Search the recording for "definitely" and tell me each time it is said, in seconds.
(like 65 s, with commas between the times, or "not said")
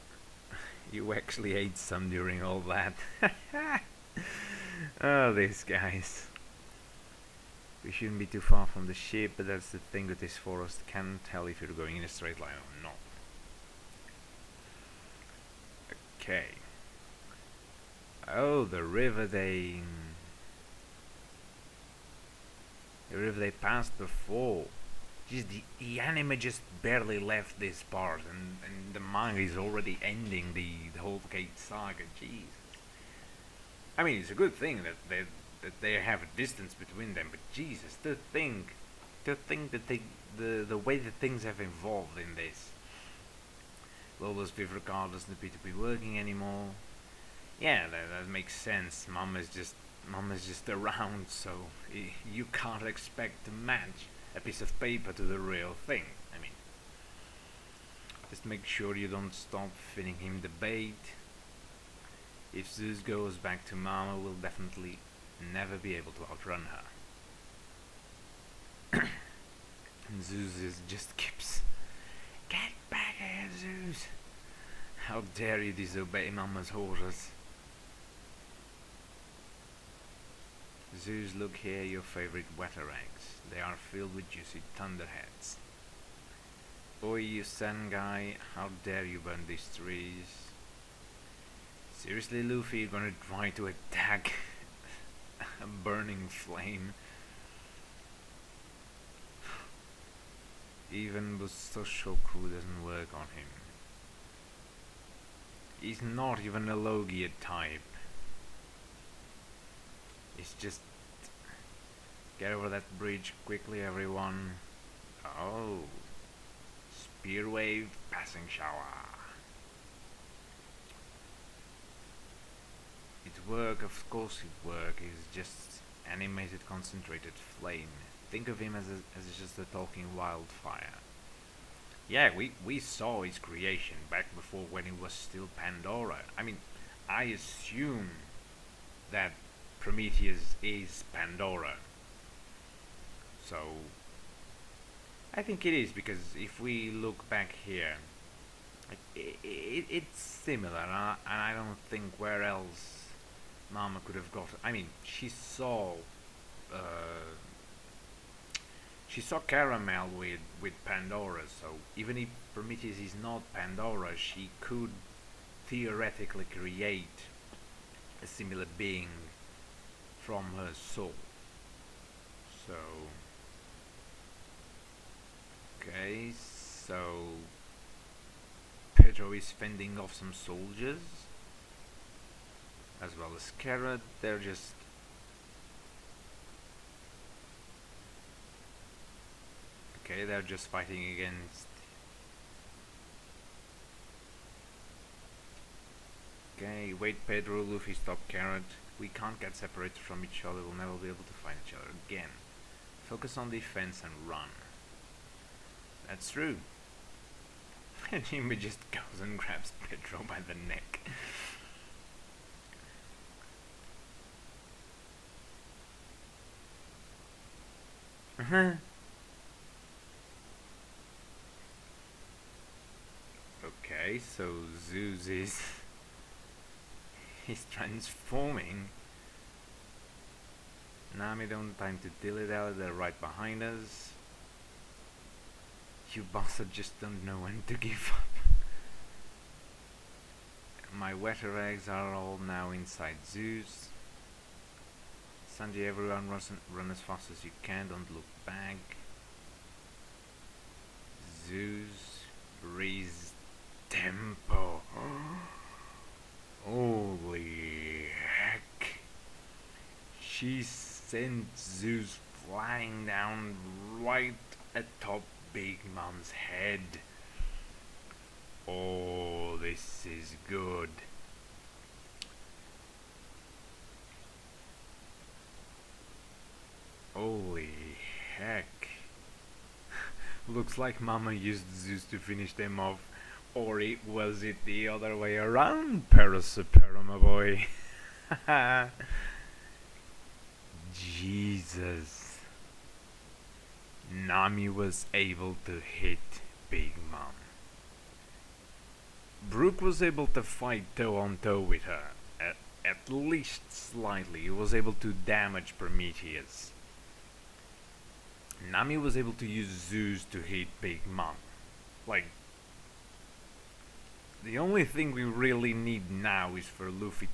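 64 s.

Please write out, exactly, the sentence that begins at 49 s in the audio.
Mom is just Mom just around, so you can't expect to match a piece of paper to the real thing.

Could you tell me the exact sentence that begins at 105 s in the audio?
He's not even a Logia type.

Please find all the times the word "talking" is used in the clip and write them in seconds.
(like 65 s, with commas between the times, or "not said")
129 s.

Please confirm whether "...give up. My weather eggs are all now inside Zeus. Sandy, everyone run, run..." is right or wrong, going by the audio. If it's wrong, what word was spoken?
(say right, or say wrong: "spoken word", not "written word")
right.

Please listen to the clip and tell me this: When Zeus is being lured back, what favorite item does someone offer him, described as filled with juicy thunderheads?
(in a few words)
watarangs.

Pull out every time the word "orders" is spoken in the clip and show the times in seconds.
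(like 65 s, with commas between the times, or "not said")
76 s.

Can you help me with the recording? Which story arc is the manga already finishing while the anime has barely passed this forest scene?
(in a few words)
Cake saga.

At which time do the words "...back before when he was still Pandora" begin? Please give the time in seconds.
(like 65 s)
134 s.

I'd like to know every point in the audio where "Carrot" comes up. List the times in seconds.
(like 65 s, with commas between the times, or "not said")
183 s, 198 s.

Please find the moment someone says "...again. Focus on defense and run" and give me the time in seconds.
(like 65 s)
202 s.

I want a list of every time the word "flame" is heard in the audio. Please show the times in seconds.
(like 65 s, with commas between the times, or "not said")
96 s, 127 s.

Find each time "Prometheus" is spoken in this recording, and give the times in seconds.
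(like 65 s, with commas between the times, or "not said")
139 s, 162 s, 305 s.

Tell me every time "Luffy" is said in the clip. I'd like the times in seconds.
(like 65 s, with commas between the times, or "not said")
92 s, 197 s.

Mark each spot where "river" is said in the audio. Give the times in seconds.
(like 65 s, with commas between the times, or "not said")
18 s, 23 s.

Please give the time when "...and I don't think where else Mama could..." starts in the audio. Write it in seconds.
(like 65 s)
151 s.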